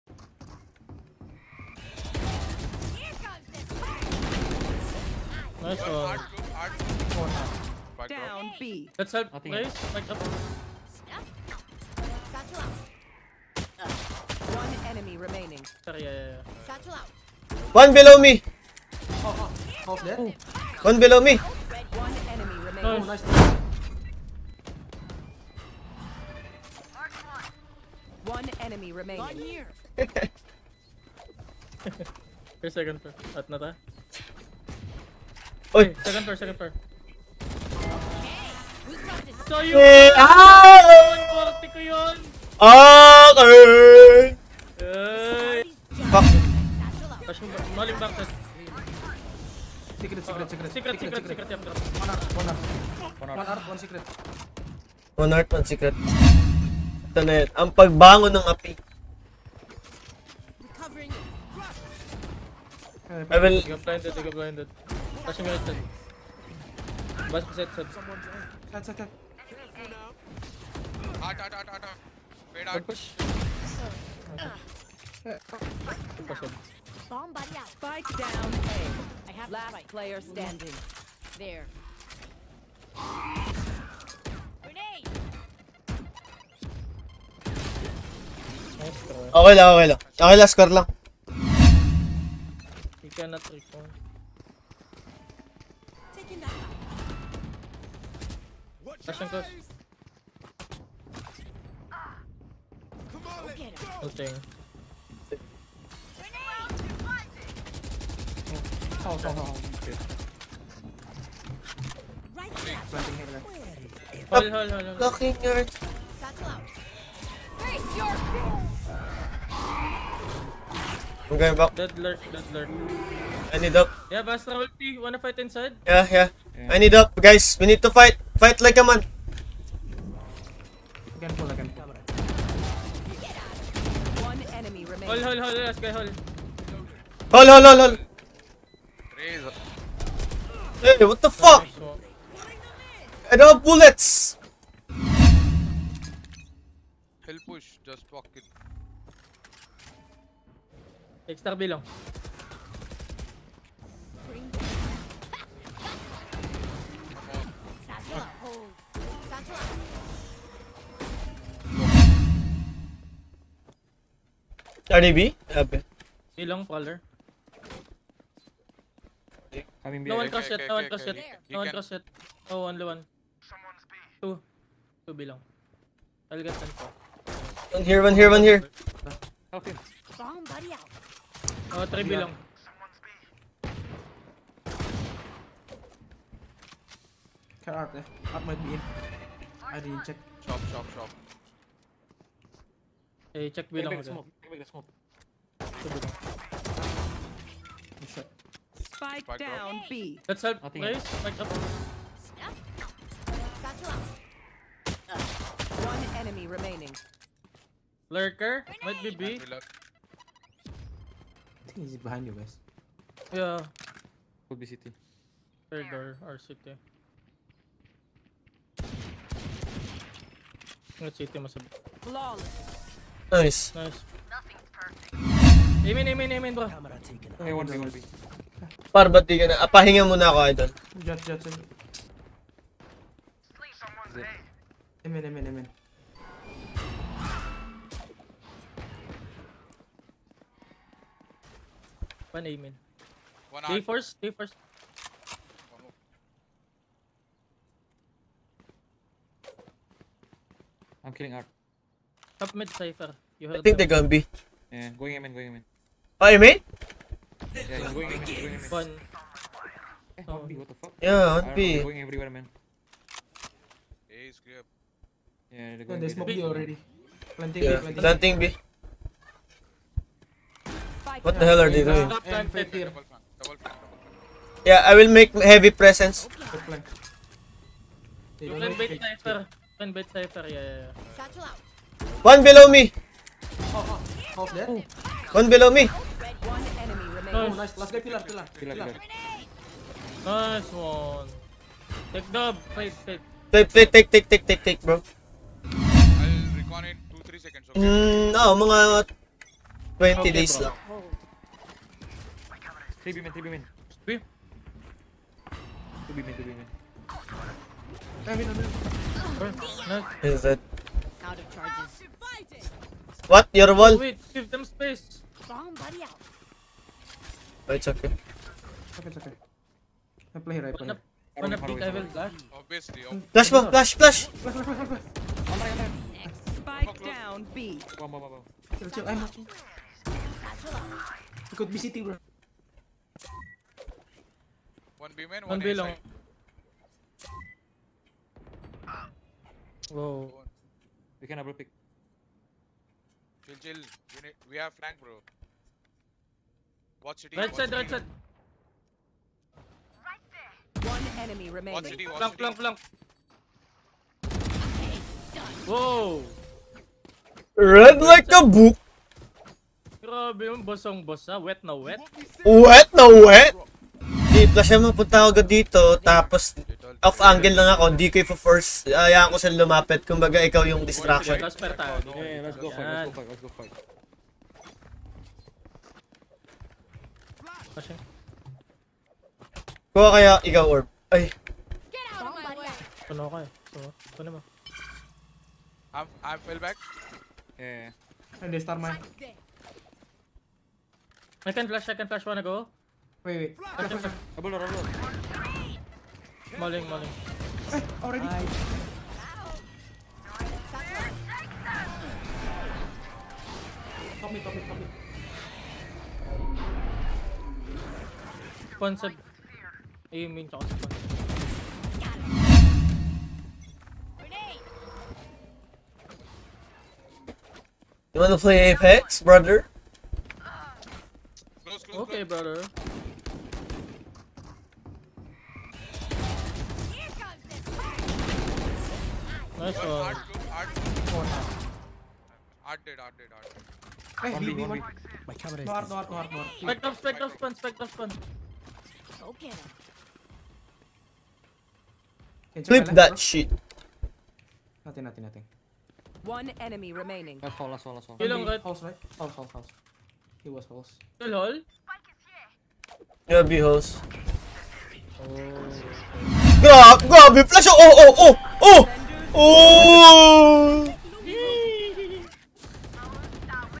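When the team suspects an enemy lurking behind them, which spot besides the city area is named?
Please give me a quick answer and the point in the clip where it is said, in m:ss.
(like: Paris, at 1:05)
Third door, at 3:35.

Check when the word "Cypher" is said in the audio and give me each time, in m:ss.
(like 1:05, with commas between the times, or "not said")
4:12.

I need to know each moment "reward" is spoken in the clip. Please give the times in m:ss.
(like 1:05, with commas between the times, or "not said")
not said.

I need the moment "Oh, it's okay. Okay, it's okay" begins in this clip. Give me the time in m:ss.
5:17.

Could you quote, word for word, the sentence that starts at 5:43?
We, need, we have flank, bro.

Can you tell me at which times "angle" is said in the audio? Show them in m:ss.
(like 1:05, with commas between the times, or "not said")
6:07.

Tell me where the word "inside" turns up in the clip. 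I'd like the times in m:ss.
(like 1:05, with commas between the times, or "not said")
2:05.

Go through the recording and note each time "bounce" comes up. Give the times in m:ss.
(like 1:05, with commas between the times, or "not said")
not said.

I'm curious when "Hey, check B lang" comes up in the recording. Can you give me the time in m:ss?
3:13.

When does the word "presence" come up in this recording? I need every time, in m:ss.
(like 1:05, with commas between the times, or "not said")
4:35.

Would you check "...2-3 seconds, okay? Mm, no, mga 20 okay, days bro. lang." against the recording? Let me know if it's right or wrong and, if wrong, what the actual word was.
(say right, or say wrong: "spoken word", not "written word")
right.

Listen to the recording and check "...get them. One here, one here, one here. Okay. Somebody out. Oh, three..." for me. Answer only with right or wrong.
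right.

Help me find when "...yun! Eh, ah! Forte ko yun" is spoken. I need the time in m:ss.
0:39.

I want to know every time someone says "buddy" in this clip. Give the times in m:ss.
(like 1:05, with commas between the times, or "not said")
1:17, 5:15.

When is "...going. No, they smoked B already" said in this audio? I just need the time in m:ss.
4:25.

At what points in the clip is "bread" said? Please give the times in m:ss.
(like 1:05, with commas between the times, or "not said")
not said.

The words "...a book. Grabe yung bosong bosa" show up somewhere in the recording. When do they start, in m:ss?
5:58.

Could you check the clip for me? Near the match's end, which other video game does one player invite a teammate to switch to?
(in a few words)
Apex.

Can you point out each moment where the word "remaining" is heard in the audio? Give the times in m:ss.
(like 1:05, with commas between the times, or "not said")
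0:15, 0:22, 0:28, 3:26, 5:51, 7:26.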